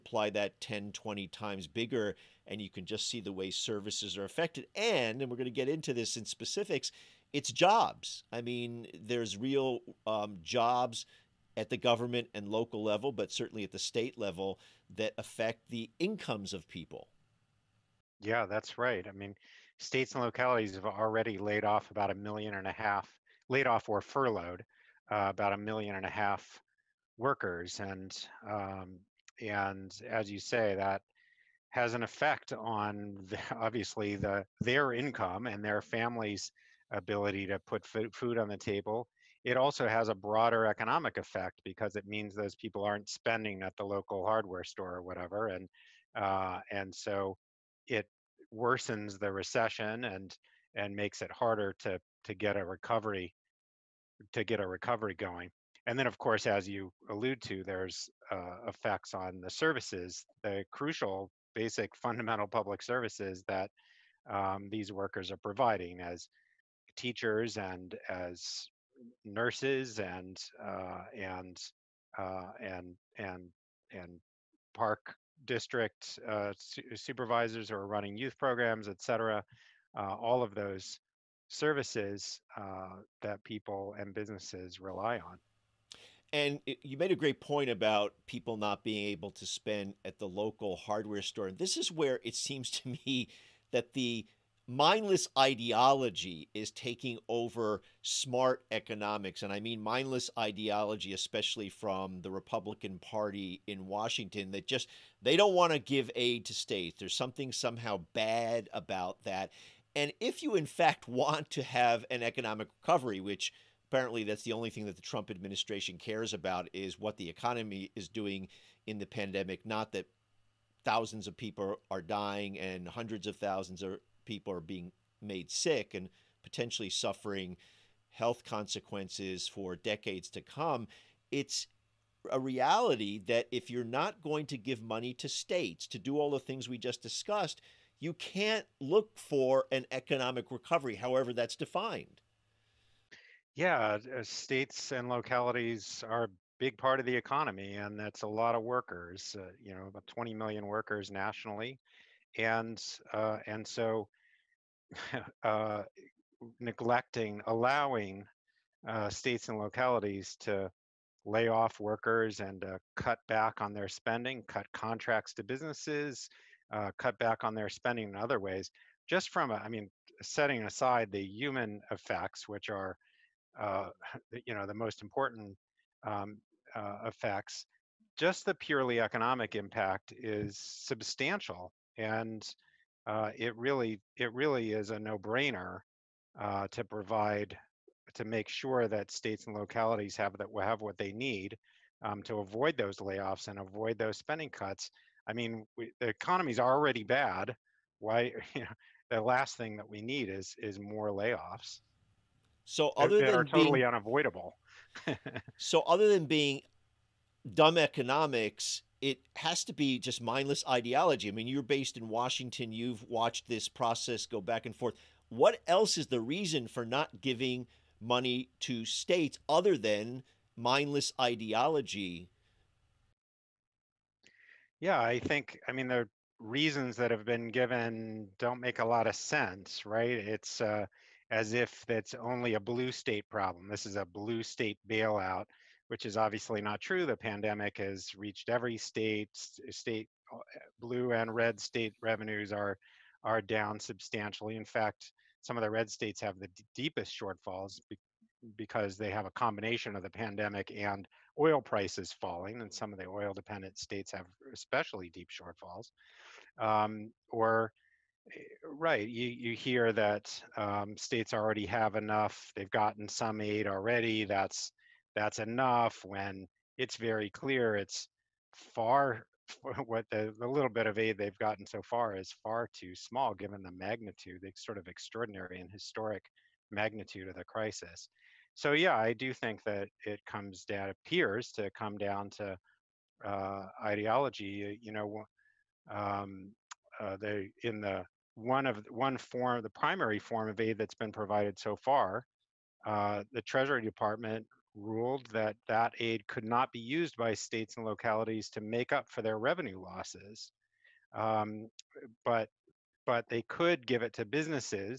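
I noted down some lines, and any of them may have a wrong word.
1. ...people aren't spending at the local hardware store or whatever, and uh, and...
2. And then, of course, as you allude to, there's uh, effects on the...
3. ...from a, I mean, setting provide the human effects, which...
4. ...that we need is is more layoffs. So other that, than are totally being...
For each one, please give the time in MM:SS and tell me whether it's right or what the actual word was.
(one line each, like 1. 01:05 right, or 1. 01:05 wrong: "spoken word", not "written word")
1. 00:42 right
2. 00:55 right
3. 02:49 wrong: "aside", not "provide"
4. 03:19 right.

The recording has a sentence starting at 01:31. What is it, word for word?
And this is where it seems to me that the mindless ideology is taking over smart economics.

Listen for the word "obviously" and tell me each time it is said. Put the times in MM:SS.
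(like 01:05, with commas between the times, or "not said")
00:33, 03:56.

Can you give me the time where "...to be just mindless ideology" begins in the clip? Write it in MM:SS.
03:29.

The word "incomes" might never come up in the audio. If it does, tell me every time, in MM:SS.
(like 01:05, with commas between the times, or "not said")
00:15, 00:34.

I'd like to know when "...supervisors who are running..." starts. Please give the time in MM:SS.
01:16.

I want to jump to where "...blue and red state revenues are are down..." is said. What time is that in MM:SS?
04:00.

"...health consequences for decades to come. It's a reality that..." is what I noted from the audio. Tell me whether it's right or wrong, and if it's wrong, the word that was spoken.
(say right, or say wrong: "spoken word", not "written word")
right.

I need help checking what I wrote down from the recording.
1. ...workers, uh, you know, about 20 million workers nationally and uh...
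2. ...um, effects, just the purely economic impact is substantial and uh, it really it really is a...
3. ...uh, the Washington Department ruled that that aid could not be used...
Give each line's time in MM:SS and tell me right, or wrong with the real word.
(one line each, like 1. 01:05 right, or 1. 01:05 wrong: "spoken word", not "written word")
1. 02:28 right
2. 02:56 right
3. 04:52 wrong: "Treasury", not "Washington".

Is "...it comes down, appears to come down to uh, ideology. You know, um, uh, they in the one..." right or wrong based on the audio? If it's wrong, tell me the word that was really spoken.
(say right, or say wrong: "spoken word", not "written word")
right.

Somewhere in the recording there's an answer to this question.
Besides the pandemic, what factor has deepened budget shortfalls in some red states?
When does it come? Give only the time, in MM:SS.
04:11.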